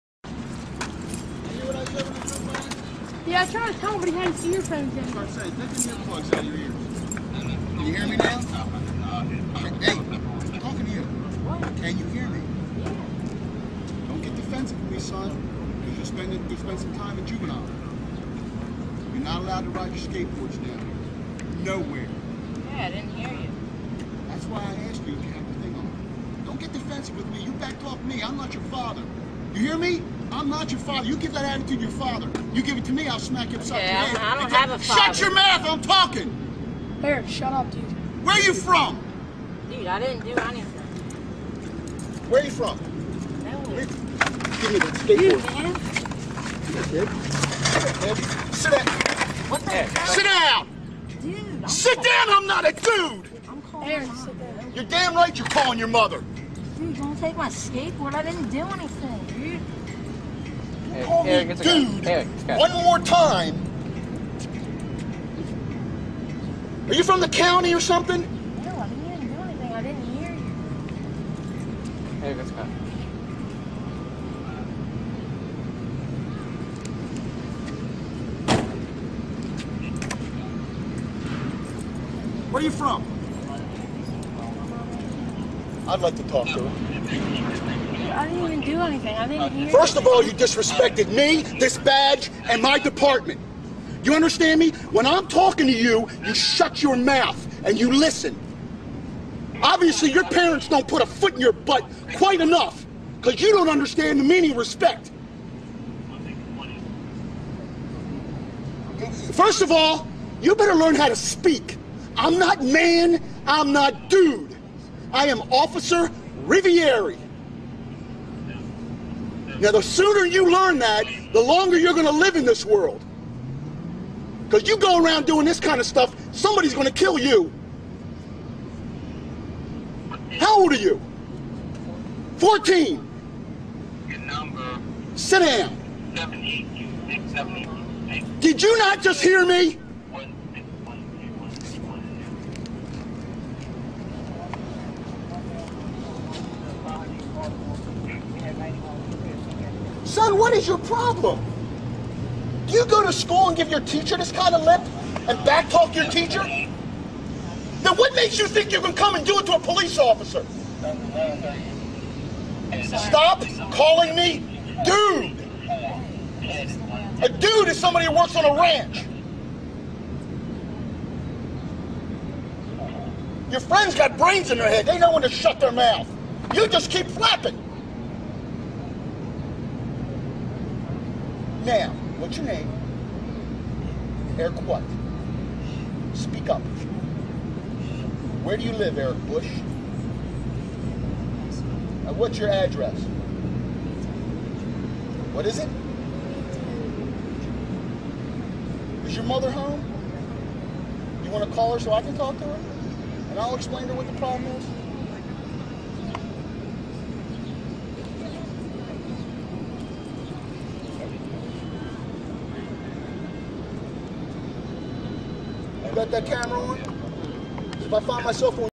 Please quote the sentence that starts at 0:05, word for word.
I was take the earplugs out of your ears.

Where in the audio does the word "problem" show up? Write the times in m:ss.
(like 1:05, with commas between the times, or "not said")
2:30, 3:24.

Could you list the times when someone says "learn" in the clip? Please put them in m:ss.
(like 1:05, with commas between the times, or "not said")
1:50, 2:00.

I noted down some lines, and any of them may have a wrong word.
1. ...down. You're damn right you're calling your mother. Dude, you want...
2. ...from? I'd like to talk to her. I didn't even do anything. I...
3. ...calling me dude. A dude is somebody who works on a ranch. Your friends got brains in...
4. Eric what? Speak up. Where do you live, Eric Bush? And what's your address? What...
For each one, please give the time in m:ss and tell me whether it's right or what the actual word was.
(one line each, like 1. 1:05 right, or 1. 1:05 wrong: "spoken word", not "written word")
1. 0:54 right
2. 1:22 right
3. 2:43 right
4. 3:04 right.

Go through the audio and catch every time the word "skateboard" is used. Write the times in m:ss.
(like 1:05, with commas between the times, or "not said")
0:20, 0:45, 0:57.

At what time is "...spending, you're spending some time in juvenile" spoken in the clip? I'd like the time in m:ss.
0:16.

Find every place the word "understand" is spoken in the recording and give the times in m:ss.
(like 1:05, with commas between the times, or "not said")
1:34, 1:43.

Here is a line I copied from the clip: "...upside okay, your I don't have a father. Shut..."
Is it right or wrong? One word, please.
right.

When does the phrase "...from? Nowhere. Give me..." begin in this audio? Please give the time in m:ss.
0:42.